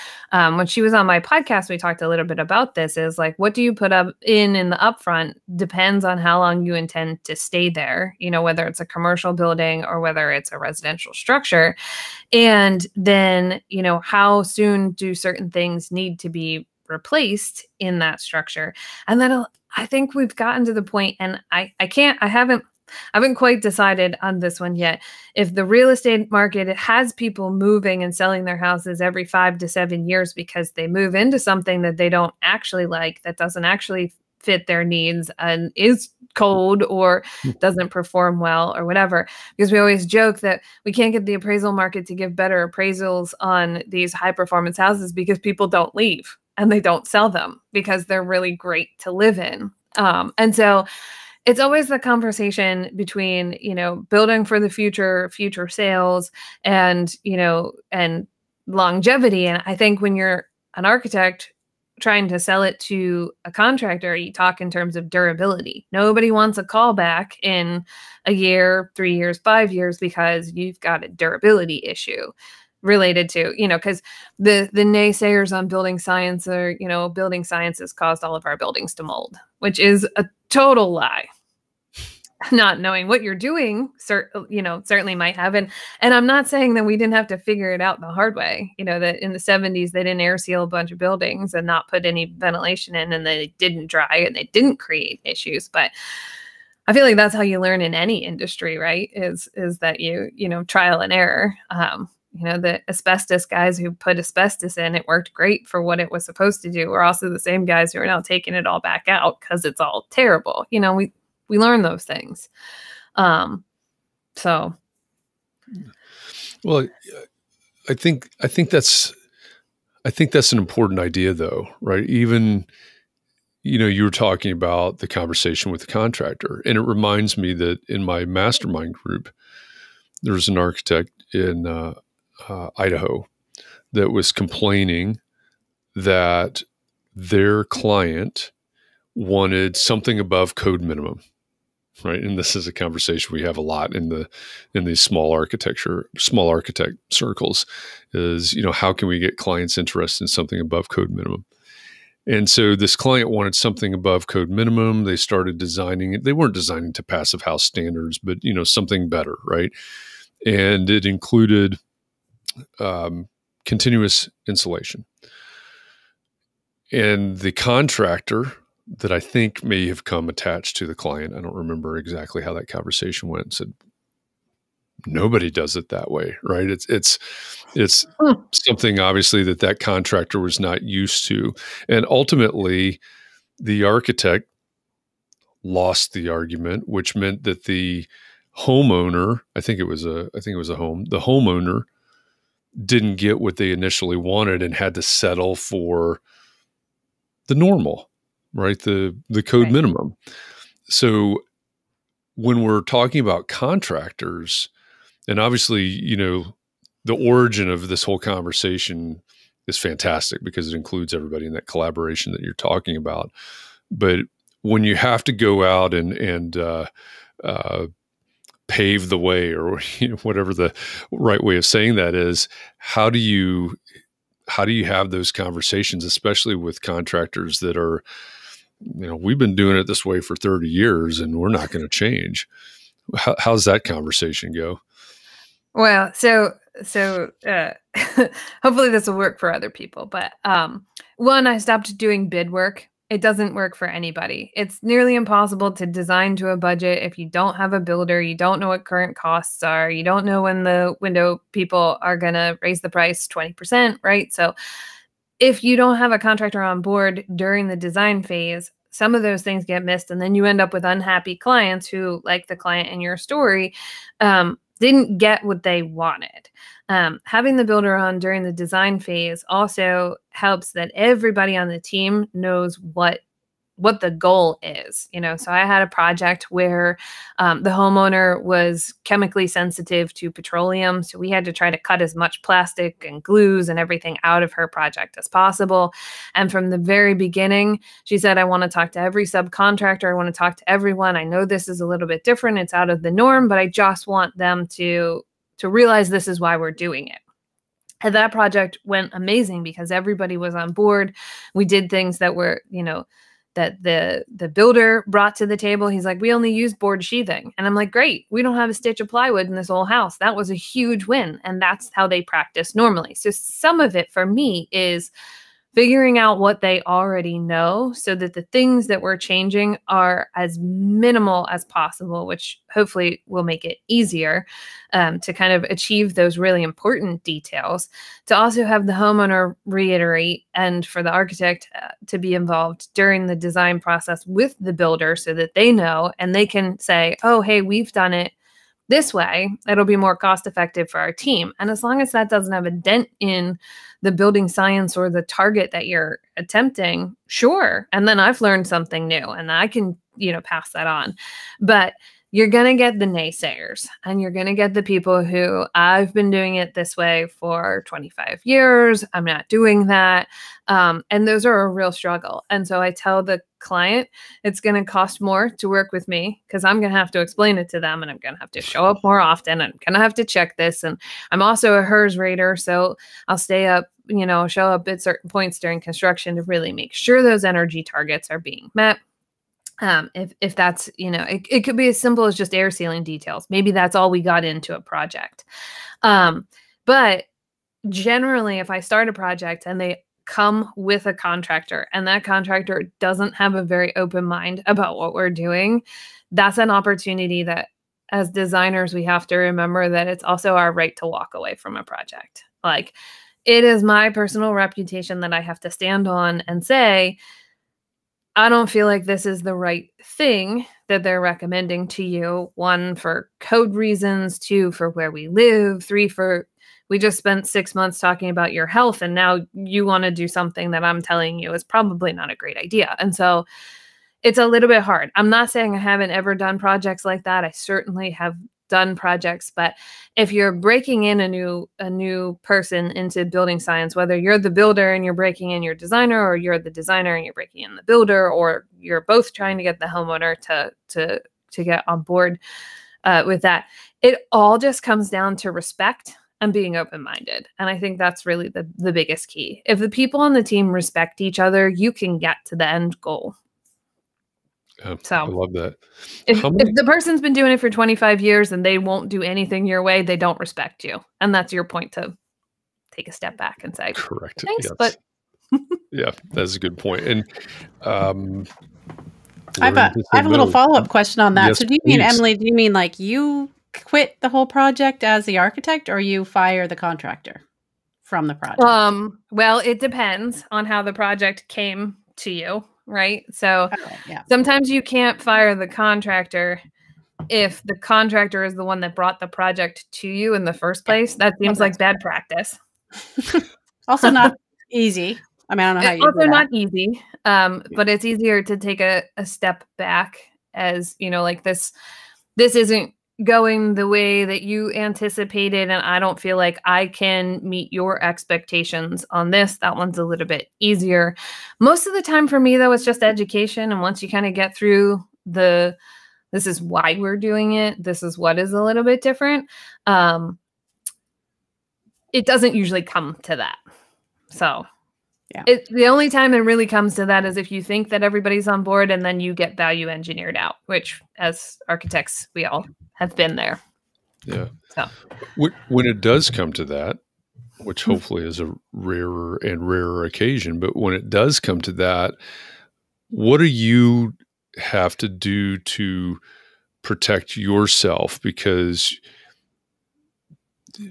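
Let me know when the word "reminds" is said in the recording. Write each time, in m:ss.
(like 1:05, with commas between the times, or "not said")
2:06.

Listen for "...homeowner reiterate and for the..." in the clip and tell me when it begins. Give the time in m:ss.
5:28.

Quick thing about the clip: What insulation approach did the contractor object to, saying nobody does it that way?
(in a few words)
continuous insulation.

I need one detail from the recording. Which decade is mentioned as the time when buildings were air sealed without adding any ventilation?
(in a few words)
the 70s.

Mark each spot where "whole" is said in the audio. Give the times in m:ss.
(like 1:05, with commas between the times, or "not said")
3:28, 5:09, 7:54.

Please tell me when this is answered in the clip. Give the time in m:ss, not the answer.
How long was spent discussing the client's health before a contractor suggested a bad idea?
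6:57.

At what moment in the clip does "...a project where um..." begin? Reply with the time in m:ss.
4:35.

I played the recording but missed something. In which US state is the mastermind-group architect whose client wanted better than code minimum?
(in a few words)
Idaho.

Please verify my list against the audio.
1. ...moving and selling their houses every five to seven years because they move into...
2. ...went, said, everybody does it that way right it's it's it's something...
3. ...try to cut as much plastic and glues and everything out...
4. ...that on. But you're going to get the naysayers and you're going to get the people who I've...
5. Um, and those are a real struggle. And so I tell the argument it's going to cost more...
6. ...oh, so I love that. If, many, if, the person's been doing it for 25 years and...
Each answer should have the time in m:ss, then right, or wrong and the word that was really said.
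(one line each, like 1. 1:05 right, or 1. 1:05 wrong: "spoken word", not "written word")
1. 0:27 right
2. 2:53 wrong: "nobody", not "everybody"
3. 4:41 right
4. 5:50 right
5. 6:00 wrong: "client", not "argument"
6. 7:34 right.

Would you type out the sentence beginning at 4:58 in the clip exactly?
And that project went amazing because everybody was on board.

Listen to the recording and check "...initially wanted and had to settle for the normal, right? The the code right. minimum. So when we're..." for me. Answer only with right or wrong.
right.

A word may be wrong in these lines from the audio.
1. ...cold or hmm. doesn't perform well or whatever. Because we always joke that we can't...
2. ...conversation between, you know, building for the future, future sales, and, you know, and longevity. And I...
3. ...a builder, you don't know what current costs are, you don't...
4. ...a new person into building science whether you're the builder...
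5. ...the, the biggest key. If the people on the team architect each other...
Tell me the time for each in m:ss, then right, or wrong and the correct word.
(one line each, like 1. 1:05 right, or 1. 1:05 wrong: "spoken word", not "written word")
1. 0:36 right
2. 0:51 right
3. 4:07 right
4. 7:11 right
5. 7:28 wrong: "respect", not "architect".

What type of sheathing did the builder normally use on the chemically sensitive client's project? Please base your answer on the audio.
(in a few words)
board sheathing.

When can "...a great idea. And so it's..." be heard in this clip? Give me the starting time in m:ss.
7:02.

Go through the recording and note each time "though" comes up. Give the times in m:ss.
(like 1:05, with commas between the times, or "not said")
2:01, 8:32.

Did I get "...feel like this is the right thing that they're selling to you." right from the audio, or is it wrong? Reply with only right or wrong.
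wrong.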